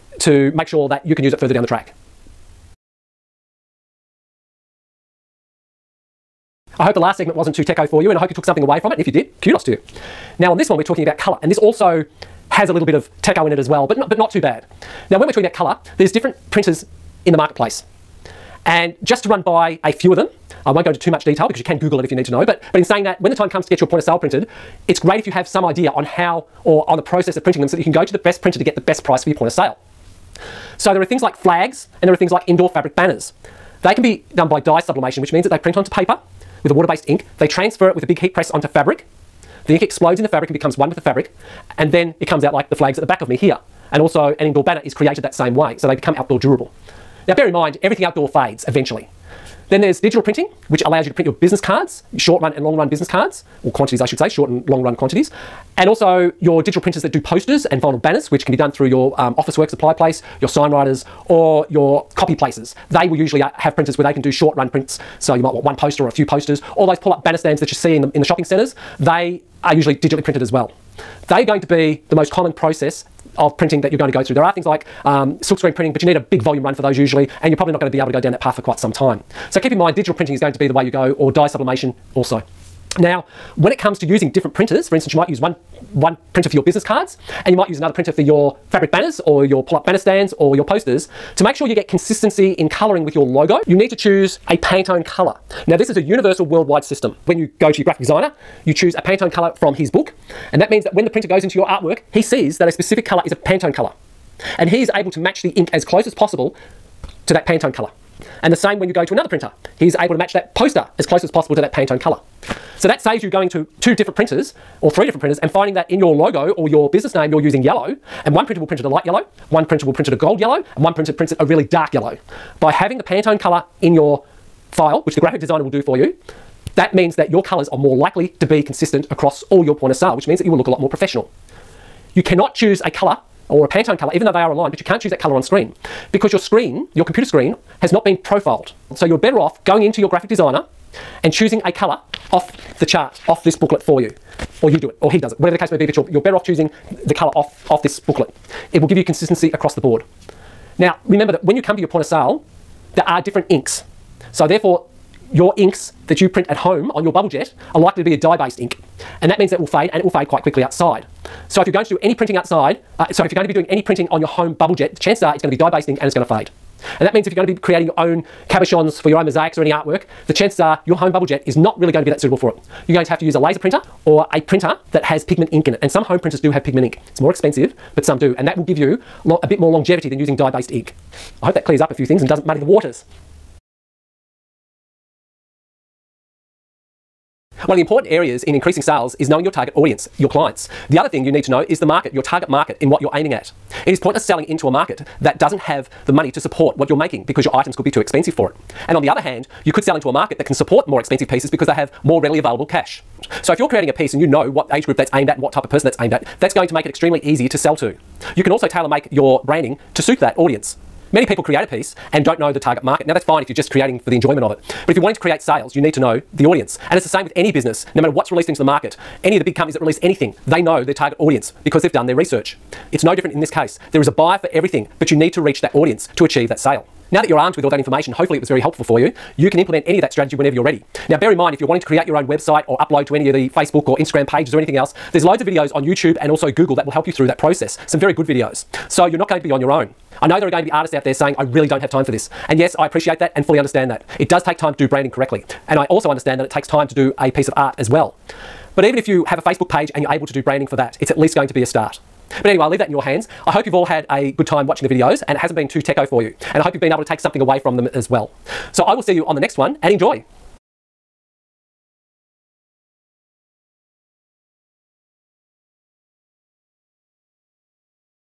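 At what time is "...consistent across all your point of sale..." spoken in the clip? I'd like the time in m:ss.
2:08.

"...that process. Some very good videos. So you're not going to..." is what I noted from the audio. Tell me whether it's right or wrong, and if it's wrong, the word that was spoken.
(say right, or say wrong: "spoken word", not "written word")
right.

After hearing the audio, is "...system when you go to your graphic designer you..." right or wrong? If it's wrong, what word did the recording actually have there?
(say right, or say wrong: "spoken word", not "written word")
right.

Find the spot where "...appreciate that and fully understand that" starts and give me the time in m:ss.
4:02.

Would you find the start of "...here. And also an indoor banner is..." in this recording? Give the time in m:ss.
0:43.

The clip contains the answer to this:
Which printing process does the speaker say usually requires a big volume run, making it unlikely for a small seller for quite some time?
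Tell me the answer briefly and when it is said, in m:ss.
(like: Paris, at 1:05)
Silkscreen printing, at 1:15.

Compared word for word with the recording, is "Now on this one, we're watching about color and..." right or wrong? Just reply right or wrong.
wrong.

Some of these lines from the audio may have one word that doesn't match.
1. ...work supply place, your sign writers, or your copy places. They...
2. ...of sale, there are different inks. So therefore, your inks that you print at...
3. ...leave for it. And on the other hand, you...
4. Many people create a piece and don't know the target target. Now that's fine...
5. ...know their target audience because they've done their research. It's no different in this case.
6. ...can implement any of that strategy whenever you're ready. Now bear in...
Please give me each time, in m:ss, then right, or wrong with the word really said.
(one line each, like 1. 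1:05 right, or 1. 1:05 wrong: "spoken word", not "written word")
1. 0:59 right
2. 2:32 right
3. 3:17 wrong: "expensive", not "leave"
4. 3:31 wrong: "market", not "target"
5. 3:40 right
6. 3:49 right.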